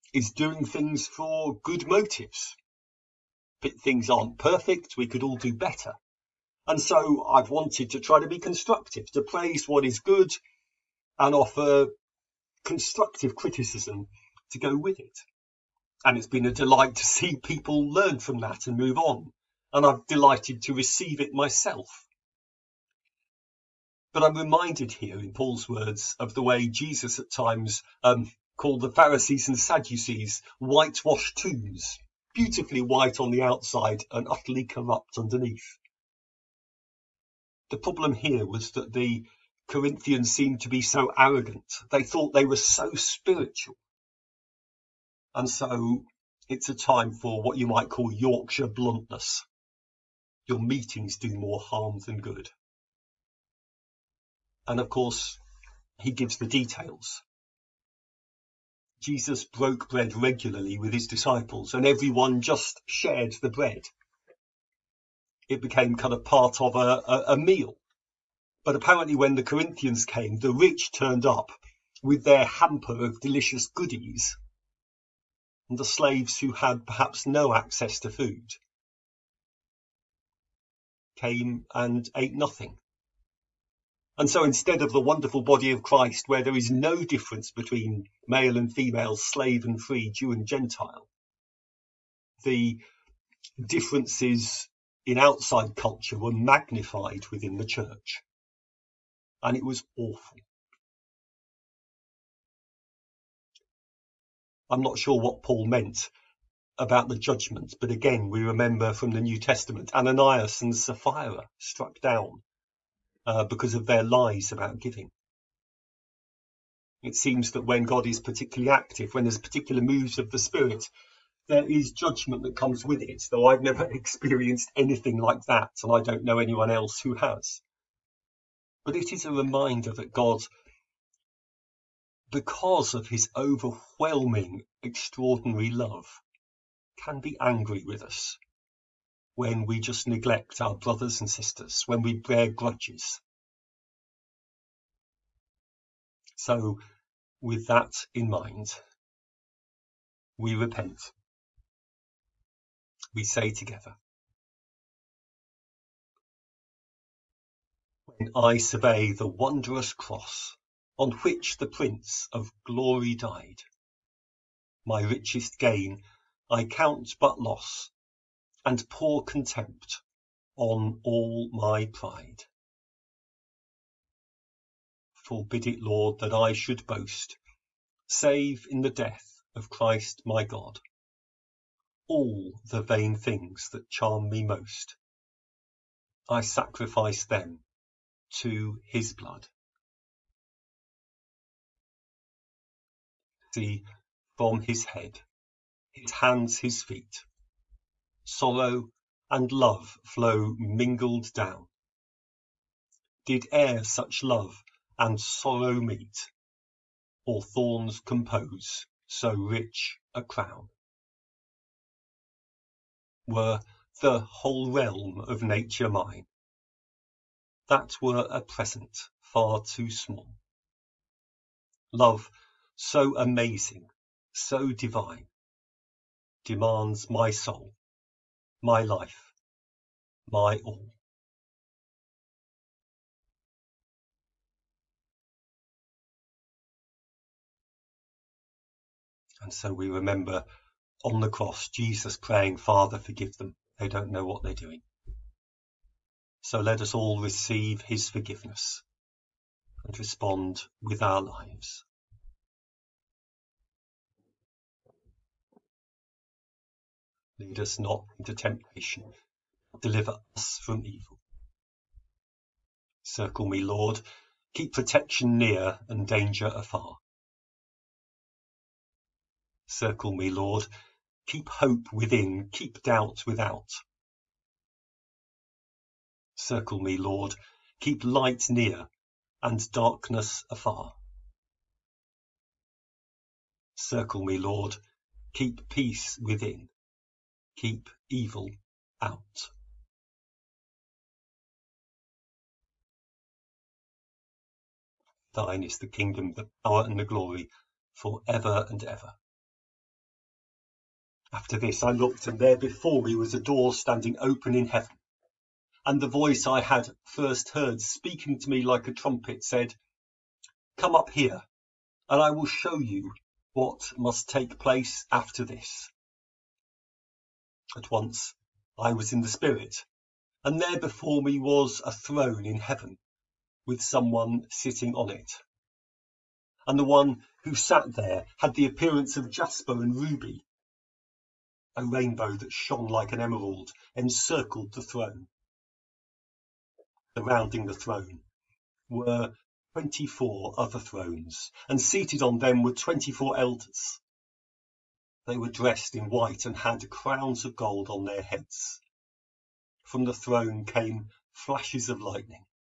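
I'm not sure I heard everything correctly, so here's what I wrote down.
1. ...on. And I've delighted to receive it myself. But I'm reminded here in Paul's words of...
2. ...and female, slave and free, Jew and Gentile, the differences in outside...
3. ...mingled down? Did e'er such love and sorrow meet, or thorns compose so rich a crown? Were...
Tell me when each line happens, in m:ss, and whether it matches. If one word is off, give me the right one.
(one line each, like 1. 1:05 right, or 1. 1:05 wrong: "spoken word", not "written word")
1. 0:18 right
2. 1:28 right
3. 3:20 right.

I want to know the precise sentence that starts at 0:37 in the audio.
The problem here was that the Corinthians seemed to be so arrogant.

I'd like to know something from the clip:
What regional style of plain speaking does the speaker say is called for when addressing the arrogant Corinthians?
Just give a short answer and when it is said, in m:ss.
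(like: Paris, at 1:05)
Yorkshire bluntness, at 0:48.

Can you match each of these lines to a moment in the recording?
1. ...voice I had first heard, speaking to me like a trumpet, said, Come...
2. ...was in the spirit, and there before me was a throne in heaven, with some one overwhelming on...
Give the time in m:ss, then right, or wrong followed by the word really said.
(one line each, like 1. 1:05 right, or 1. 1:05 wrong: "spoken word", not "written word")
1. 5:06 right
2. 5:18 wrong: "sitting", not "overwhelming".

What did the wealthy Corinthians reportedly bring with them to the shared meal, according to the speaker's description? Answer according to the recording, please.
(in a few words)
hamper of delicious goodies.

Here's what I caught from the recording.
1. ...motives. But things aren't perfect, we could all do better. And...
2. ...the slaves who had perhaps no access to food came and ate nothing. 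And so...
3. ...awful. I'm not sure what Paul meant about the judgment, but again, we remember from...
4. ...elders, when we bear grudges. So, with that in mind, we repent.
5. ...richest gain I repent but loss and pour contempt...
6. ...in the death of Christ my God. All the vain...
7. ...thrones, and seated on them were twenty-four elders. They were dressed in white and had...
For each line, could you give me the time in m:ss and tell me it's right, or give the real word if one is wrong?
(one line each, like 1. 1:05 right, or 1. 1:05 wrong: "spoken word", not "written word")
1. 0:01 right
2. 1:15 right
3. 1:39 right
4. 2:21 wrong: "sisters", not "elders"
5. 2:45 wrong: "count", not "repent"
6. 2:58 right
7. 5:40 right.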